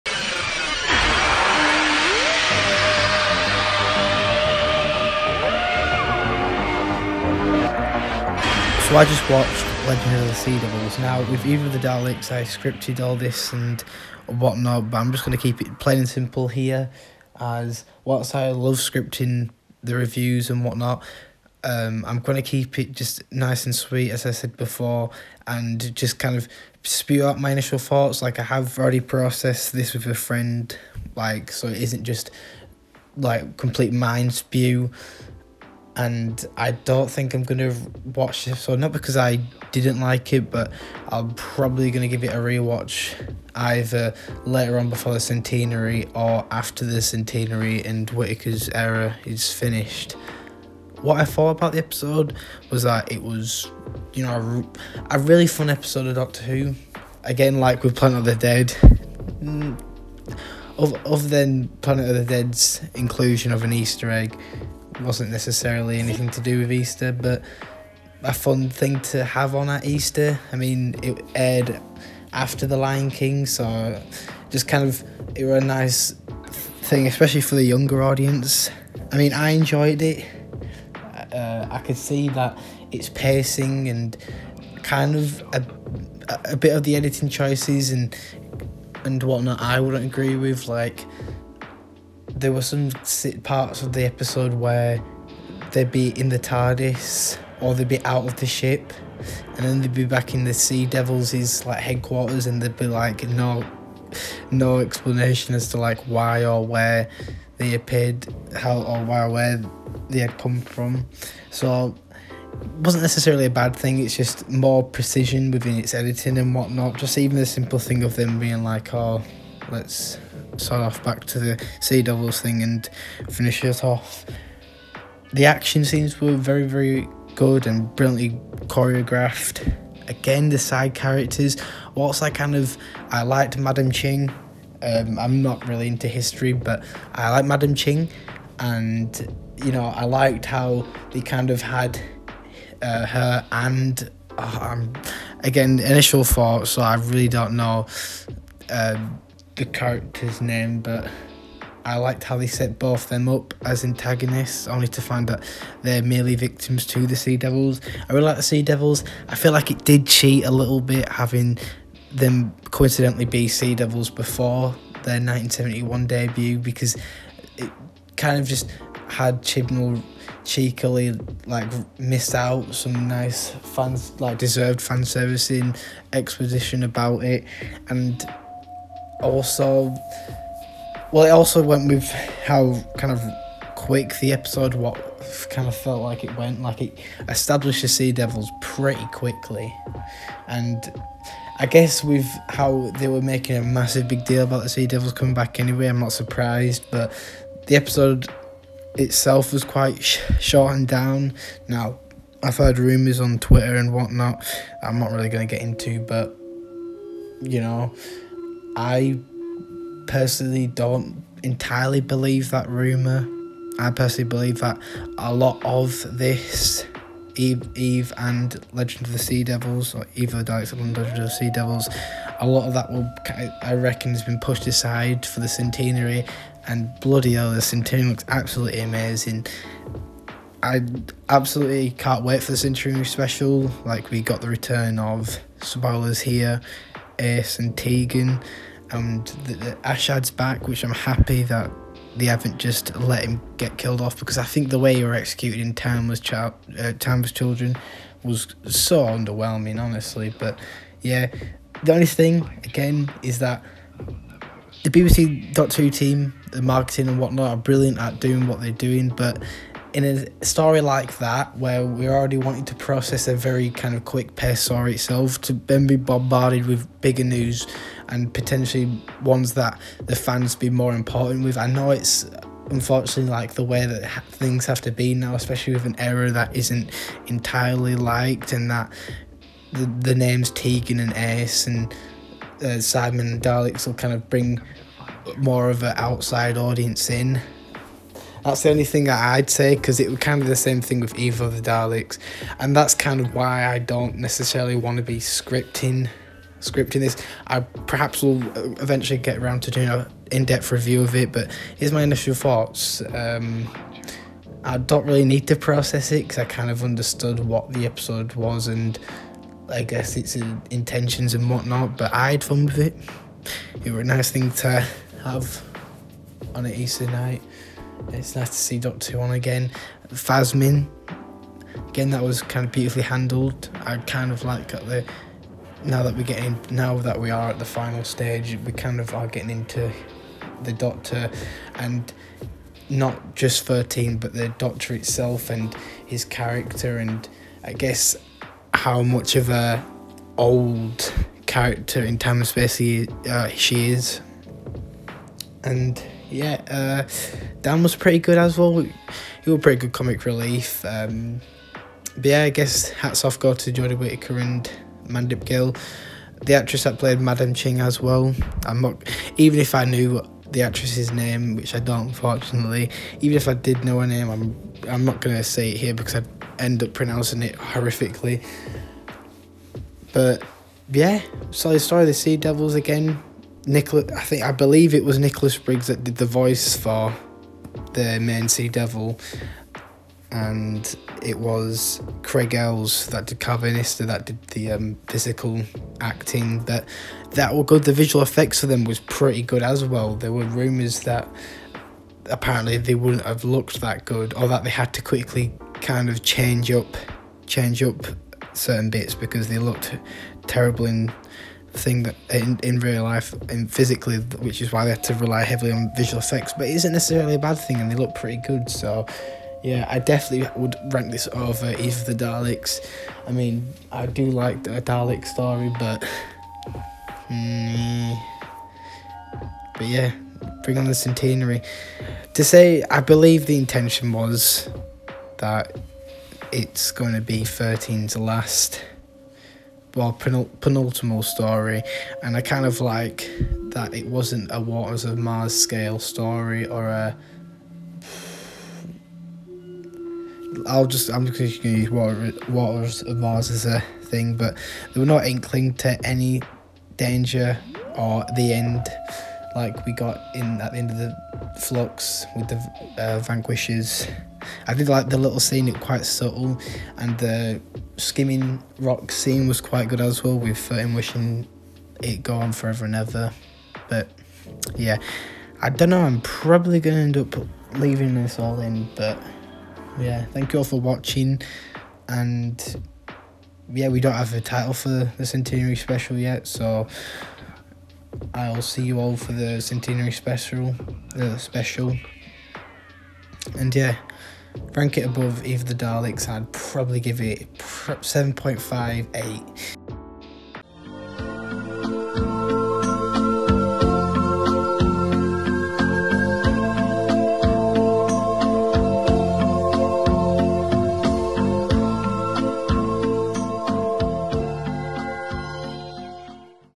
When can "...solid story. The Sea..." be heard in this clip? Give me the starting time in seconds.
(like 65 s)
371 s.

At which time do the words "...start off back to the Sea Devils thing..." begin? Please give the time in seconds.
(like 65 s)
120 s.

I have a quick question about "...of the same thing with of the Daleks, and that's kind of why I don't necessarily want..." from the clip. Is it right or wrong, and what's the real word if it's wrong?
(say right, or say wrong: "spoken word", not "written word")
right.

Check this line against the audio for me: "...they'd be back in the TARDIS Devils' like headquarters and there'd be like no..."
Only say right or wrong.
wrong.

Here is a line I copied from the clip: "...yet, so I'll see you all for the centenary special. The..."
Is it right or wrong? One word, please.
right.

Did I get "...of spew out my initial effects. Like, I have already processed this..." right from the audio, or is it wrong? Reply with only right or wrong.
wrong.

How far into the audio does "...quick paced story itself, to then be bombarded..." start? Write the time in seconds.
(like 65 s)
264 s.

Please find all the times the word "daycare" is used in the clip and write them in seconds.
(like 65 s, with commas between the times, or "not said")
not said.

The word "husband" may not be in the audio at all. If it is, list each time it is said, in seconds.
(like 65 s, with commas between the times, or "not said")
not said.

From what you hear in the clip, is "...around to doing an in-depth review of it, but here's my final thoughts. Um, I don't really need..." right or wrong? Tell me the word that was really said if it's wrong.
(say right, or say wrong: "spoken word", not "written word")
wrong: "initial", not "final".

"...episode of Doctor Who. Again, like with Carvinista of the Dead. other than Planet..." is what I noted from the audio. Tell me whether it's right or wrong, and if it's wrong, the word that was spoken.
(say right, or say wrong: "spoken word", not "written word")
wrong: "Planet", not "Carvinista".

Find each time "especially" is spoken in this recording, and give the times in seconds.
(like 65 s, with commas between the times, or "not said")
77 s, 275 s.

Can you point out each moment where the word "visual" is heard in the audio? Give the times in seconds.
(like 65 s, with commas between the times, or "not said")
387 s, 405 s.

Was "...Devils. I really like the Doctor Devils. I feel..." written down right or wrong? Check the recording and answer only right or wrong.
wrong.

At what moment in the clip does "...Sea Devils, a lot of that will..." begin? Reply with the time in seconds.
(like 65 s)
221 s.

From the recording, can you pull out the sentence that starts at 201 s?
Now, I've heard rumours on Twitter and whatnot.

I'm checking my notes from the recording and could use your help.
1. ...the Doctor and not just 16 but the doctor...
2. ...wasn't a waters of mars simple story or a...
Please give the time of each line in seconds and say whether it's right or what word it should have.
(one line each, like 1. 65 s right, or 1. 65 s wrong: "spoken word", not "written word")
1. 330 s wrong: "13", not "16"
2. 434 s wrong: "scale", not "simple".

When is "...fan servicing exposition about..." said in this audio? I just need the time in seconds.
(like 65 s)
174 s.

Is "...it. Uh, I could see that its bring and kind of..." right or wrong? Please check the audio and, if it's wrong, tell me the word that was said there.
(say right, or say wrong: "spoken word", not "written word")
wrong: "pacing", not "bring".